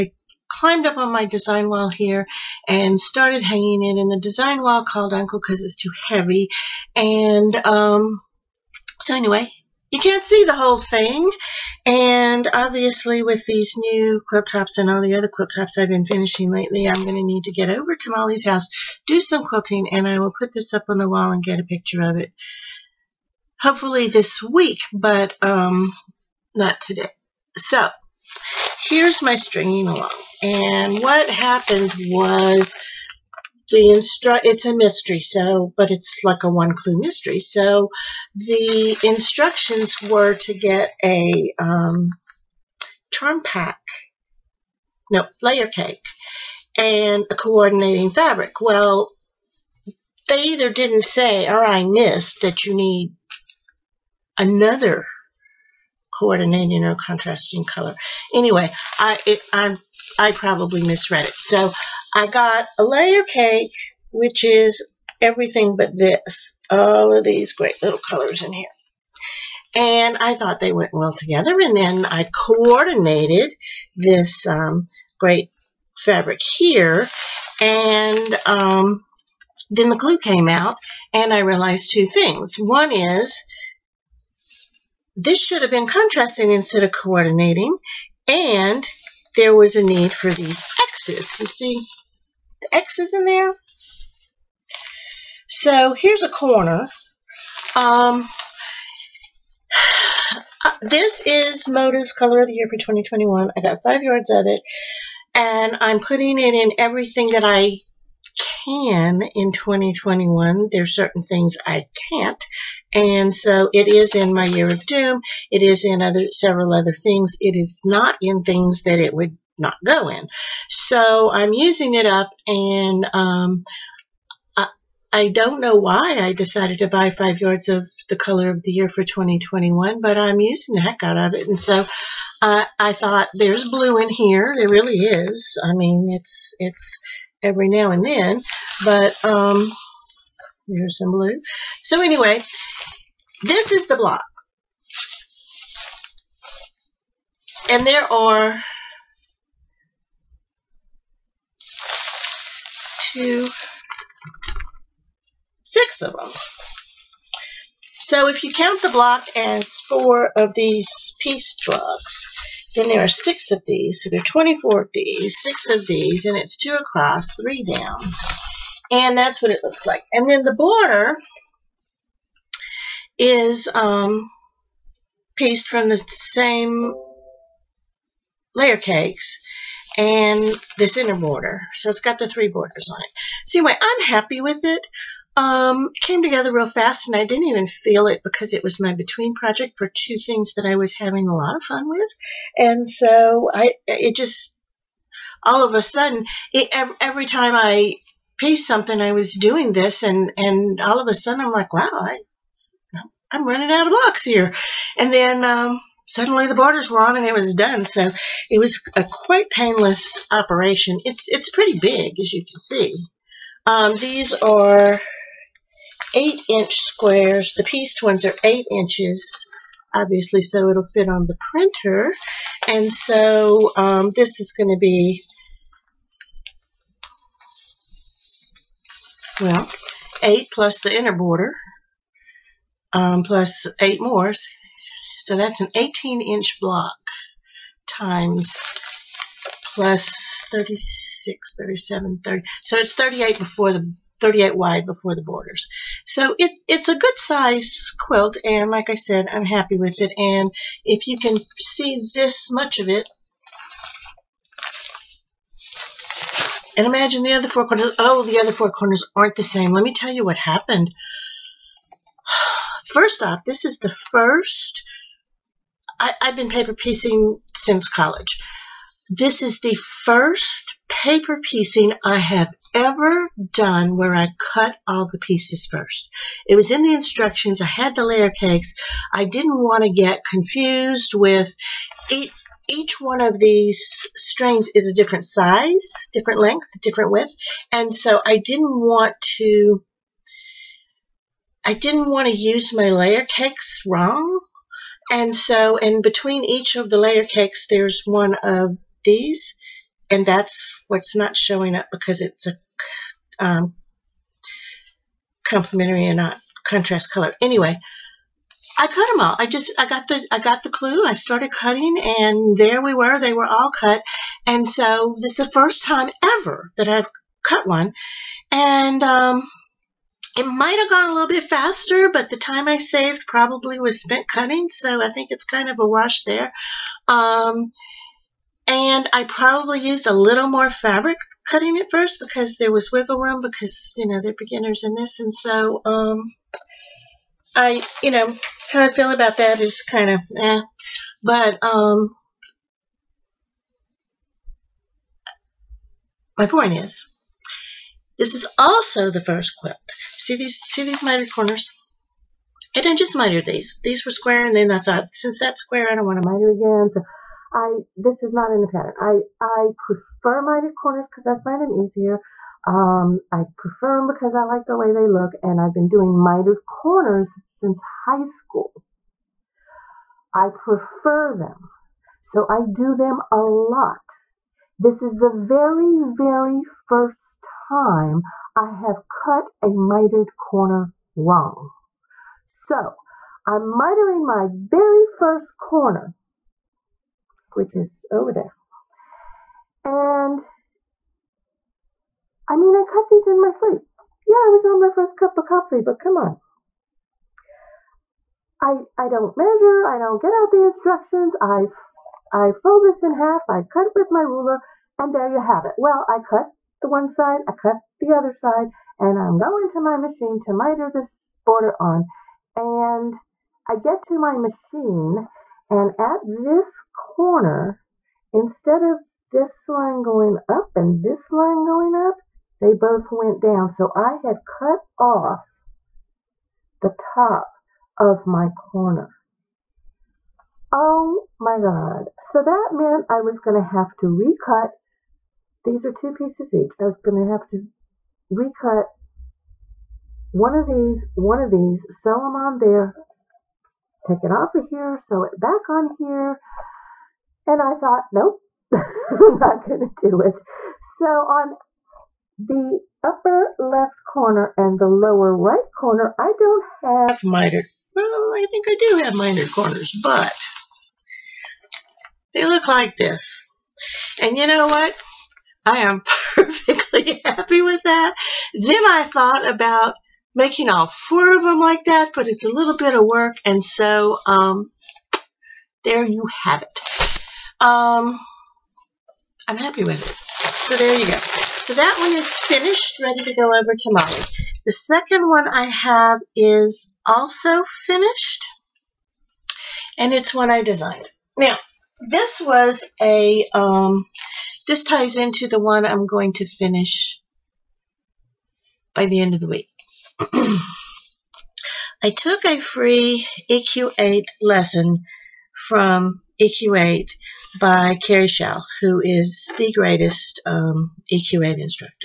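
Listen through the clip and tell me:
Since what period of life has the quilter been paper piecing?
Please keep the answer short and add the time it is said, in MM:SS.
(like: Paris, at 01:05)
College, at 04:27.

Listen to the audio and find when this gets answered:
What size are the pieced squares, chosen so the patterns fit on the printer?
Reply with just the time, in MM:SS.
03:36.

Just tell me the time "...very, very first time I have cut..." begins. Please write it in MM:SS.
06:15.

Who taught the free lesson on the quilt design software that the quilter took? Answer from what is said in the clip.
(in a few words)
Carrie Shell.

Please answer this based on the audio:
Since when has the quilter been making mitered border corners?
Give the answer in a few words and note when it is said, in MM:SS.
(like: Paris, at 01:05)
High school, at 06:07.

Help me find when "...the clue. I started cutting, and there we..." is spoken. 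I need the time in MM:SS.
05:10.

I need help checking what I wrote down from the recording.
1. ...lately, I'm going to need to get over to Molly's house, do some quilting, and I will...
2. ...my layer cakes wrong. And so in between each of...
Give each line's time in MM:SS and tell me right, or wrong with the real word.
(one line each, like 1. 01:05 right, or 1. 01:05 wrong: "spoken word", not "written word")
1. 00:16 right
2. 04:52 right.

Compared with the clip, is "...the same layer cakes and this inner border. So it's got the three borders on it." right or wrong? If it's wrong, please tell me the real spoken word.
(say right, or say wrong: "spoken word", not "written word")
right.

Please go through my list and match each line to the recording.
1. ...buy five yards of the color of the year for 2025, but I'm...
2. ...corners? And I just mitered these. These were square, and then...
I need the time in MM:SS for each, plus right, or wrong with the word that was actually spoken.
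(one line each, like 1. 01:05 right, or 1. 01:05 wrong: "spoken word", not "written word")
1. 02:06 wrong: "2021", not "2025"
2. 05:51 right.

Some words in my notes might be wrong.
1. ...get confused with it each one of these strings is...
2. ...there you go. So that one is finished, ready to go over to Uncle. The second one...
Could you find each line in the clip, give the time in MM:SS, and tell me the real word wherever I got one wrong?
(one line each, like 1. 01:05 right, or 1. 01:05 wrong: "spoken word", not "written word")
1. 04:39 right
2. 08:00 wrong: "Molly", not "Uncle".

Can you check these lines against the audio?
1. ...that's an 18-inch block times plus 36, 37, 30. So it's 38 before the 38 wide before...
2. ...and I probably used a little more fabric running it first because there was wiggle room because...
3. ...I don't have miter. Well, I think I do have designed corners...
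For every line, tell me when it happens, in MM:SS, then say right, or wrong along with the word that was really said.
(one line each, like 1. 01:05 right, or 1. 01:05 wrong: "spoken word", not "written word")
1. 03:55 right
2. 05:28 wrong: "cutting", not "running"
3. 07:36 wrong: "mitered", not "designed".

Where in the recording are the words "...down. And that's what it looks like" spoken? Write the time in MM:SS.
02:47.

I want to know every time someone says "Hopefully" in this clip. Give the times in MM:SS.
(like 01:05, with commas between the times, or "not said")
00:23.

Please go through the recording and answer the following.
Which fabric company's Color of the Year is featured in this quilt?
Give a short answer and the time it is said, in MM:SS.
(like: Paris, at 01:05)
Moda, at 01:41.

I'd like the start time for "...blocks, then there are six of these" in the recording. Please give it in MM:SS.
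02:41.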